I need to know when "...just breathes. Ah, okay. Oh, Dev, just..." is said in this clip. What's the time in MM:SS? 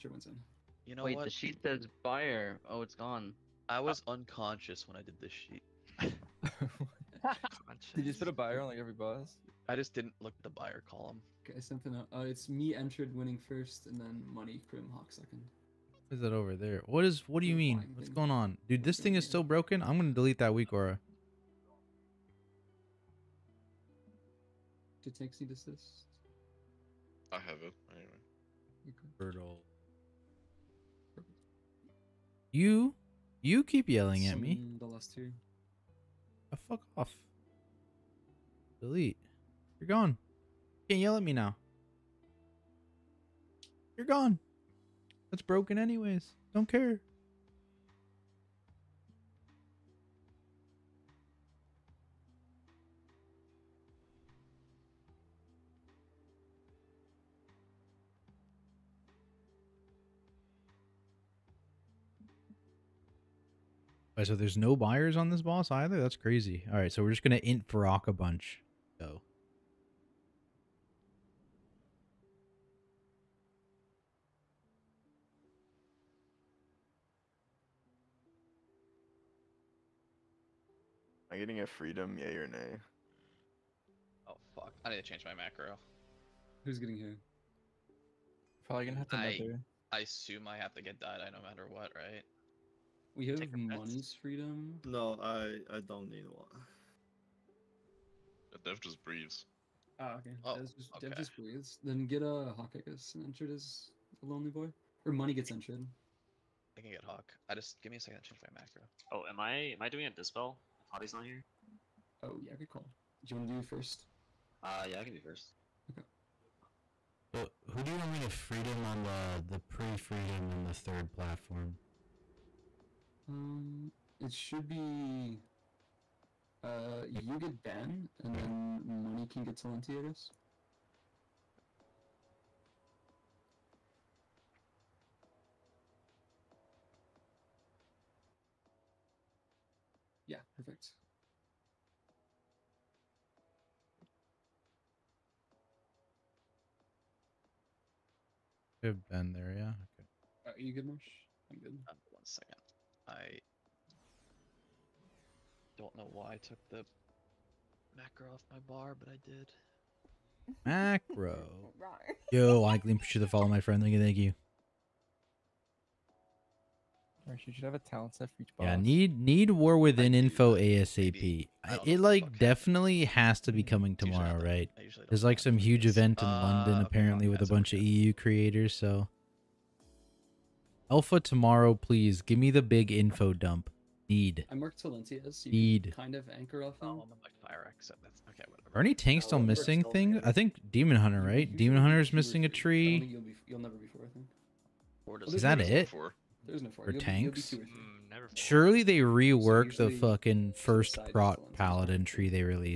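01:38.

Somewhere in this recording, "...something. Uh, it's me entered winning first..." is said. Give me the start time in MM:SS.
00:11.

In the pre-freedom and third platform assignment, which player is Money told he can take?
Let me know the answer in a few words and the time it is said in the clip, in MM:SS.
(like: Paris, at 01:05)
Talenti, at 02:09.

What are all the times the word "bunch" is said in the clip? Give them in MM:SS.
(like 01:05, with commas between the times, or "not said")
01:08, 02:57.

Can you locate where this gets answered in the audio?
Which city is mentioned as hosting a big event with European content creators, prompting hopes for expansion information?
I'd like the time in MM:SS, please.
02:56.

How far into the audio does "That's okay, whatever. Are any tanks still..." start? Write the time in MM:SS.
03:08.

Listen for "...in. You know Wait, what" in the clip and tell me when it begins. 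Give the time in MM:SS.
00:00.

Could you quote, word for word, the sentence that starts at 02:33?
I don't know why I took the macro off my bar, but I did.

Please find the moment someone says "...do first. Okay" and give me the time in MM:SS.
01:55.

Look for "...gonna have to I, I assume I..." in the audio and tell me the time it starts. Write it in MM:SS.
01:28.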